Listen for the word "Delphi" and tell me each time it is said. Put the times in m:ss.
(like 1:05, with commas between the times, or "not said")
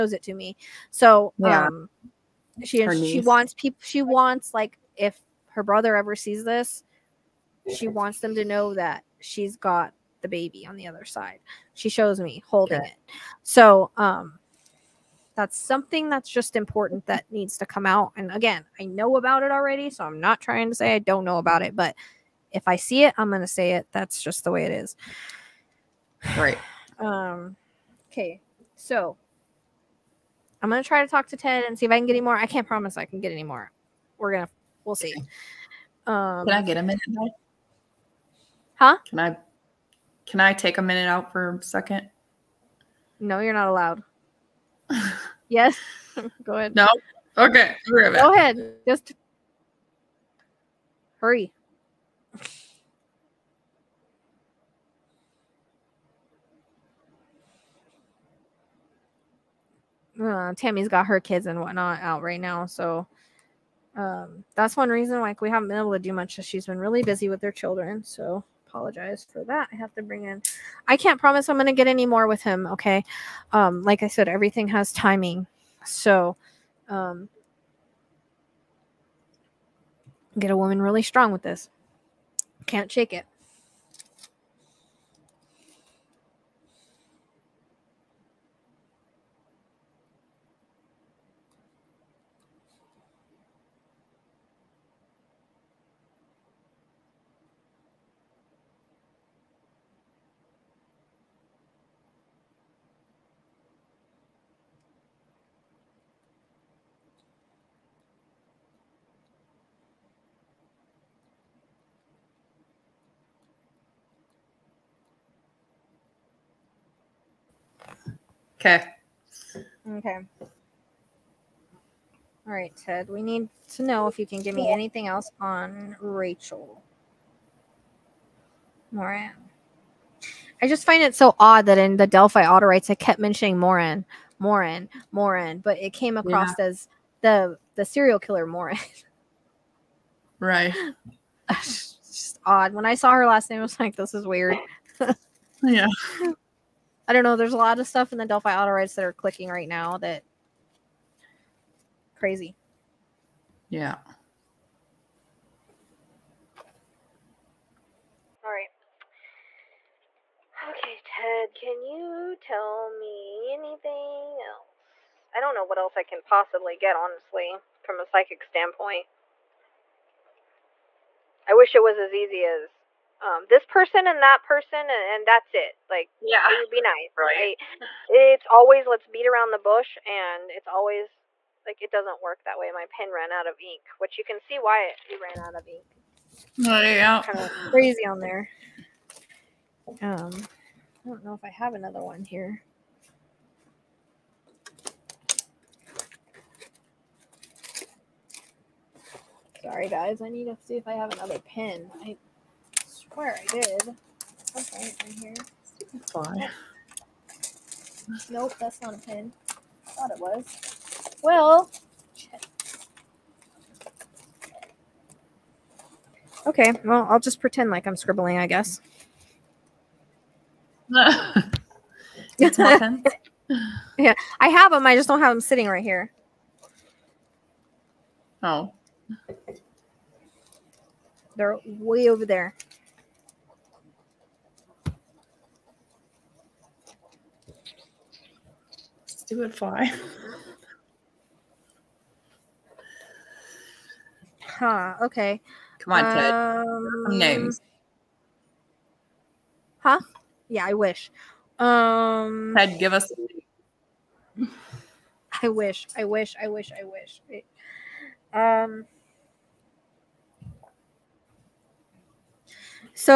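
2:12, 2:28.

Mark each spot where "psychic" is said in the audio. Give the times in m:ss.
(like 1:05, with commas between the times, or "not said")
2:48.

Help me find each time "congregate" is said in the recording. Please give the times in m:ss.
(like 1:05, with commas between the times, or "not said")
not said.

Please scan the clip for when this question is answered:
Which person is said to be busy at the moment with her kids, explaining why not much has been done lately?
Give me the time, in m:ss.
1:00.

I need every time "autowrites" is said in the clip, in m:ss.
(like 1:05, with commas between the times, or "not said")
2:12, 2:28.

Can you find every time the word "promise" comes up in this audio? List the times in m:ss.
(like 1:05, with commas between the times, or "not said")
0:32, 1:11.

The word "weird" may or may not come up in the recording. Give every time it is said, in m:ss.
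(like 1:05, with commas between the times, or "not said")
2:24.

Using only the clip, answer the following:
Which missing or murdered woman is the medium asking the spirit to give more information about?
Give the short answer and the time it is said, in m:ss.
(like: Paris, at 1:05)
Rachel Morin, at 2:06.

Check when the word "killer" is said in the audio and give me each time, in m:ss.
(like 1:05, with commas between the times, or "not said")
2:18.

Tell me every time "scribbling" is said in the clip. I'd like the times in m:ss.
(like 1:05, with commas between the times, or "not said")
3:37.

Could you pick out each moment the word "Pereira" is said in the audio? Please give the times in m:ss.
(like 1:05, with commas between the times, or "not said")
not said.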